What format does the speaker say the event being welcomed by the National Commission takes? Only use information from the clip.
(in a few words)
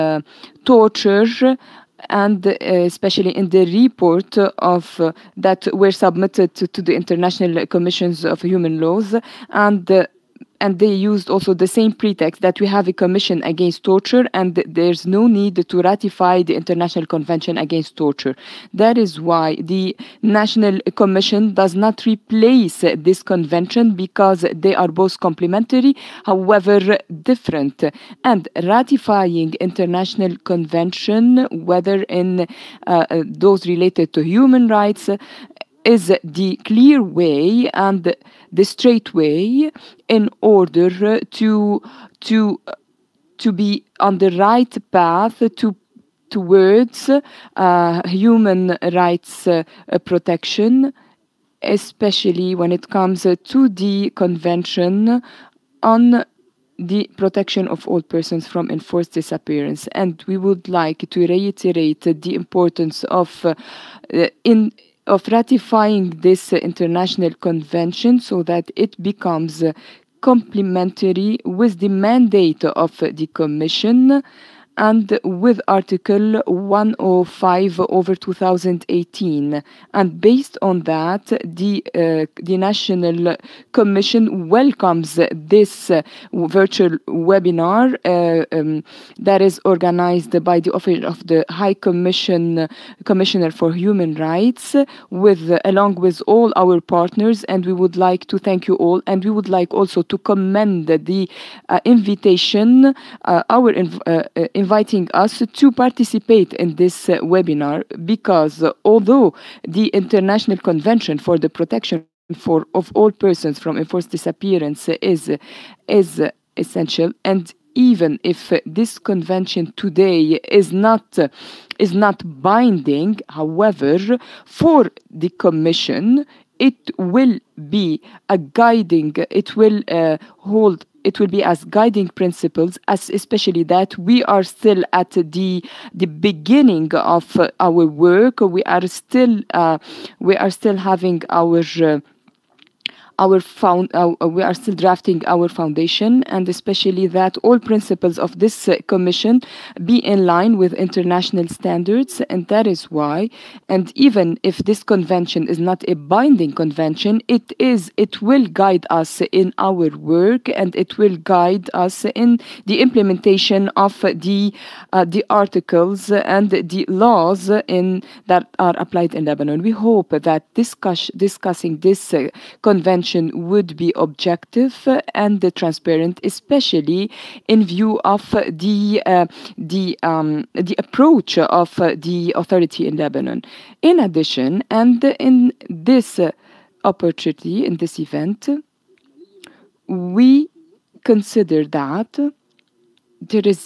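virtual webinar.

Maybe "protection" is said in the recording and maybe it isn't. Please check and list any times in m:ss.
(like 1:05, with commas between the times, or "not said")
0:50, 0:57, 1:51.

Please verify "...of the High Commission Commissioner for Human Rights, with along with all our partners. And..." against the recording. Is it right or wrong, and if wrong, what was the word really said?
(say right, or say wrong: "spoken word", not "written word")
right.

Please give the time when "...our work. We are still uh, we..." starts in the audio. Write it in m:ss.
2:17.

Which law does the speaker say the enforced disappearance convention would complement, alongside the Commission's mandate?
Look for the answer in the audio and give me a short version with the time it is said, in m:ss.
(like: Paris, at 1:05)
Article 105 of 2018, at 1:15.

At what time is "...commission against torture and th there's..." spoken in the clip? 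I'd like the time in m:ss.
0:12.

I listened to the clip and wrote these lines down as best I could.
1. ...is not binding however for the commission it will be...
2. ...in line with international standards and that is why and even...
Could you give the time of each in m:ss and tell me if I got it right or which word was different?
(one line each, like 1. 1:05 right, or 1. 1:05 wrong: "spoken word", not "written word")
1. 2:01 right
2. 2:29 right.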